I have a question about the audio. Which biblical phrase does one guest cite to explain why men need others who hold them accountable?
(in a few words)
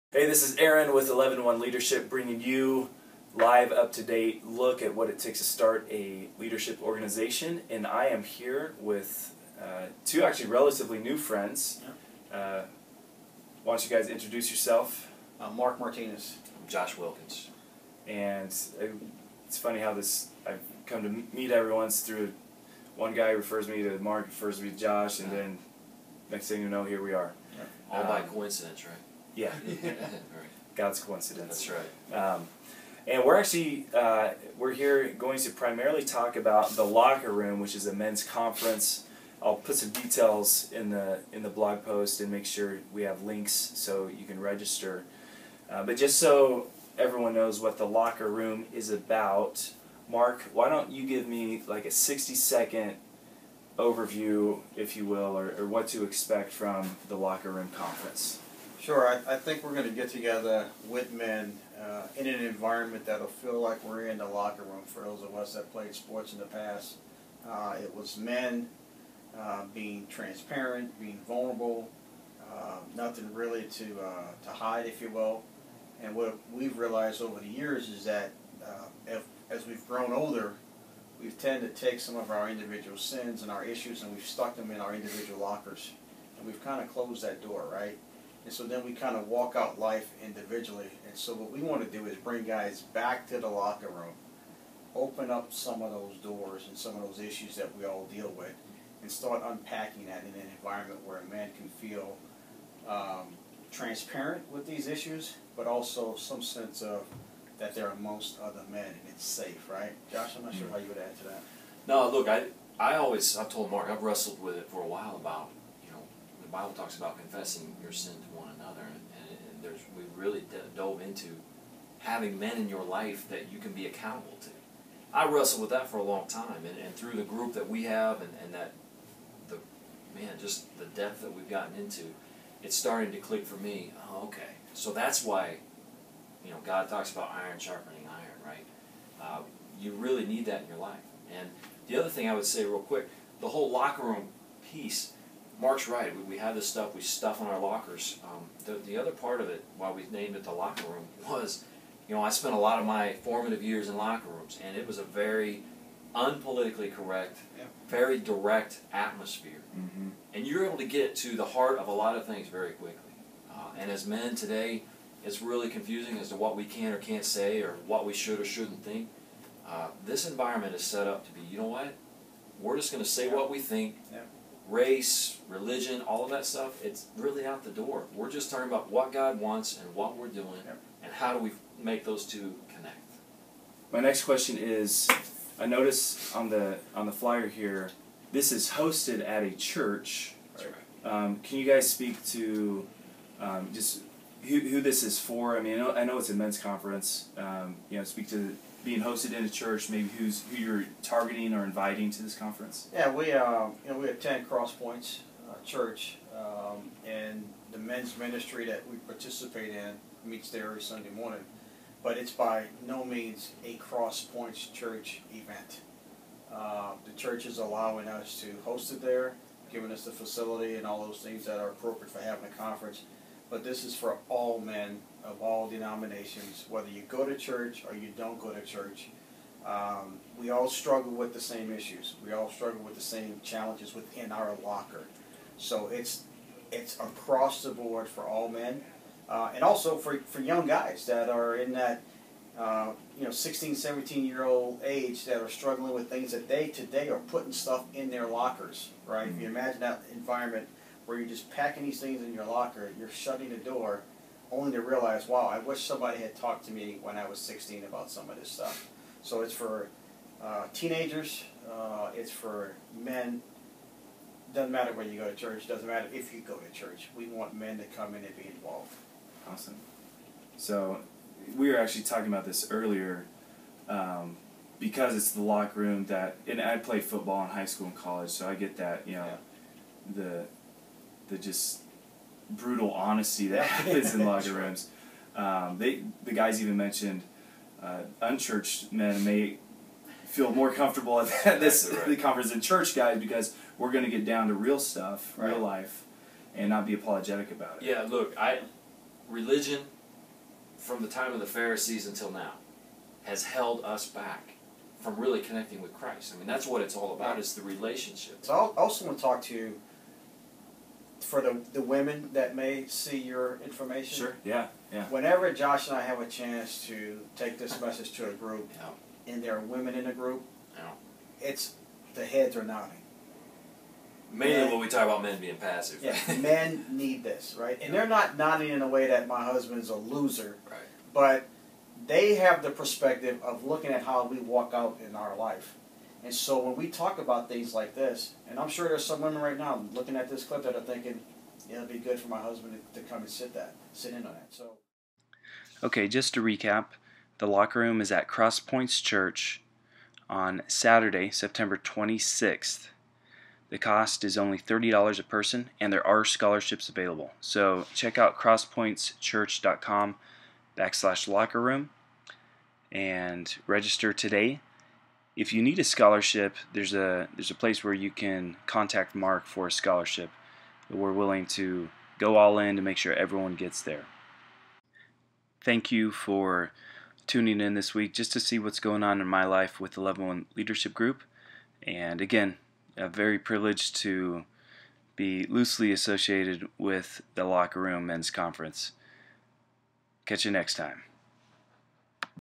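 iron sharpening iron.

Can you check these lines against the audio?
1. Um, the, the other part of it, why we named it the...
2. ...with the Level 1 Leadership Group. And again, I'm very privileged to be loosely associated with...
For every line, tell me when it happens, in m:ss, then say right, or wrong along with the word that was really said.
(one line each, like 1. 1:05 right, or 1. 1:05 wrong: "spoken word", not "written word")
1. 2:28 right
2. 6:19 right.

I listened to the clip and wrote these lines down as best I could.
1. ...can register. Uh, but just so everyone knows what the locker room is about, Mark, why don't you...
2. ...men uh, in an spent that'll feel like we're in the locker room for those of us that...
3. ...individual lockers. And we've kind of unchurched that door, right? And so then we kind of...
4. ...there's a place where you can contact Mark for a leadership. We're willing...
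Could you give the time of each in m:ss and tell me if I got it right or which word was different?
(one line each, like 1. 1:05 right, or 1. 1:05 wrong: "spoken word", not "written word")
1. 0:44 right
2. 1:01 wrong: "environment", not "spent"
3. 1:24 wrong: "closed", not "unchurched"
4. 6:07 wrong: "scholarship", not "leadership".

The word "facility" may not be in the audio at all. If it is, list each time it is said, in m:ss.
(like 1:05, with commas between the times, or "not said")
3:40.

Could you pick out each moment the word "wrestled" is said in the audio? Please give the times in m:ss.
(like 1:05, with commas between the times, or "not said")
1:54, 2:05.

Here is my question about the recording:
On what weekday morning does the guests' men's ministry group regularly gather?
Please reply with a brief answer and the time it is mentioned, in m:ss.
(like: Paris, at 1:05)
Sunday, at 3:30.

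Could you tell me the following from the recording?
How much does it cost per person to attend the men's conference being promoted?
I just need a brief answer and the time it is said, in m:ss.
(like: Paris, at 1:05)
$30, at 5:54.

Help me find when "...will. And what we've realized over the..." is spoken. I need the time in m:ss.
1:15.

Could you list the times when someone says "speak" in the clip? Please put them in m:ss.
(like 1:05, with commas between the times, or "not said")
3:11, 3:18.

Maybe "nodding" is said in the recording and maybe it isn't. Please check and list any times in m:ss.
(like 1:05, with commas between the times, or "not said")
5:22, 5:28.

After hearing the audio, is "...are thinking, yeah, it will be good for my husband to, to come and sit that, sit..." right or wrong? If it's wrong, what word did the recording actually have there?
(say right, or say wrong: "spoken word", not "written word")
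right.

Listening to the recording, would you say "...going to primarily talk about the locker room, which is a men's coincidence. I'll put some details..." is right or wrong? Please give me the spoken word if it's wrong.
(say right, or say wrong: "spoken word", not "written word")
wrong: "conference", not "coincidence".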